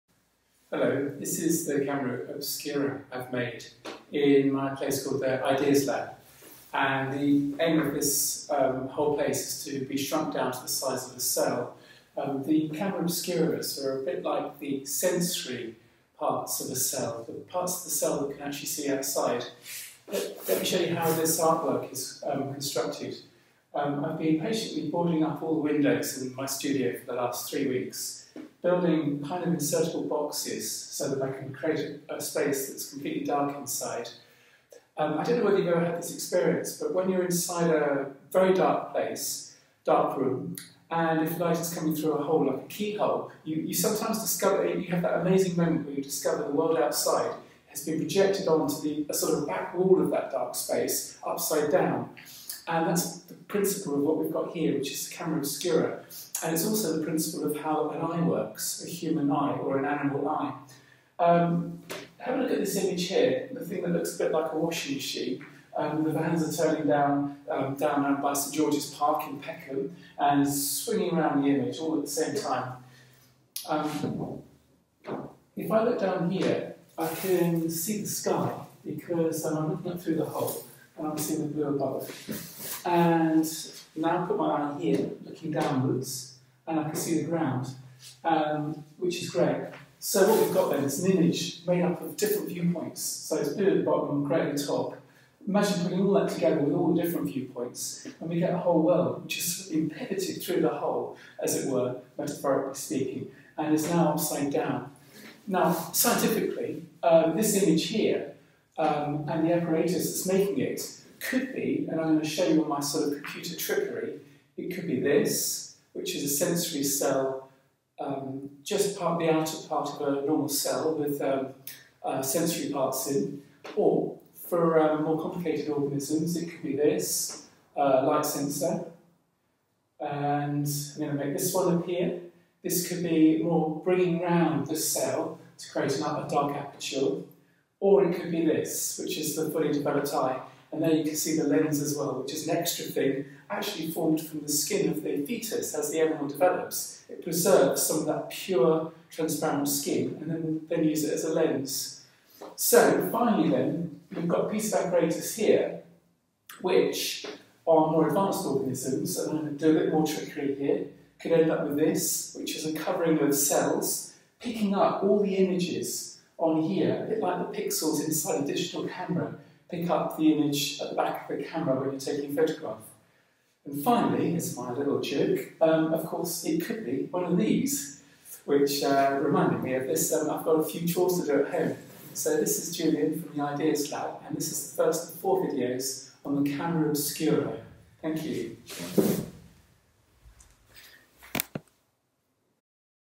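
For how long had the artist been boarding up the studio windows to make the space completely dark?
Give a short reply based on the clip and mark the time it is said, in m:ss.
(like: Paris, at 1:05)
3 weeks, at 0:27.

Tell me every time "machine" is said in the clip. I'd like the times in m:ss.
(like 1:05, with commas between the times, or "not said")
1:04.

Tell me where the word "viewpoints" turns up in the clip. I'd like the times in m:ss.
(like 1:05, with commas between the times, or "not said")
1:32, 1:37.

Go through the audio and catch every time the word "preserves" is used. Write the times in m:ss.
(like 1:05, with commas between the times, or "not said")
2:27.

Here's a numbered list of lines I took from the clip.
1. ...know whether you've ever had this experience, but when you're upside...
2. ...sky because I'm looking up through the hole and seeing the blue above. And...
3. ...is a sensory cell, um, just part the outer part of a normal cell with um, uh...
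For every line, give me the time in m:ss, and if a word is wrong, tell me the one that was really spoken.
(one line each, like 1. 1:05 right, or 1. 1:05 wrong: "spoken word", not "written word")
1. 0:35 wrong: "inside", not "upside"
2. 1:18 right
3. 1:56 right.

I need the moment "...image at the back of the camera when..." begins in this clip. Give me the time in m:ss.
2:50.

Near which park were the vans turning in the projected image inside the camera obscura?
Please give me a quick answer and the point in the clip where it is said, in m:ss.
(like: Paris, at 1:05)
St George's Park, at 1:08.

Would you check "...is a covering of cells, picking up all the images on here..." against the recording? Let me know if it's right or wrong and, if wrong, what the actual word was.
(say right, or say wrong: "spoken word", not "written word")
right.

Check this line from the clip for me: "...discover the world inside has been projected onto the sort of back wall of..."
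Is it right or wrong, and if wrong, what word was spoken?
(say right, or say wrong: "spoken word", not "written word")
wrong: "outside", not "inside".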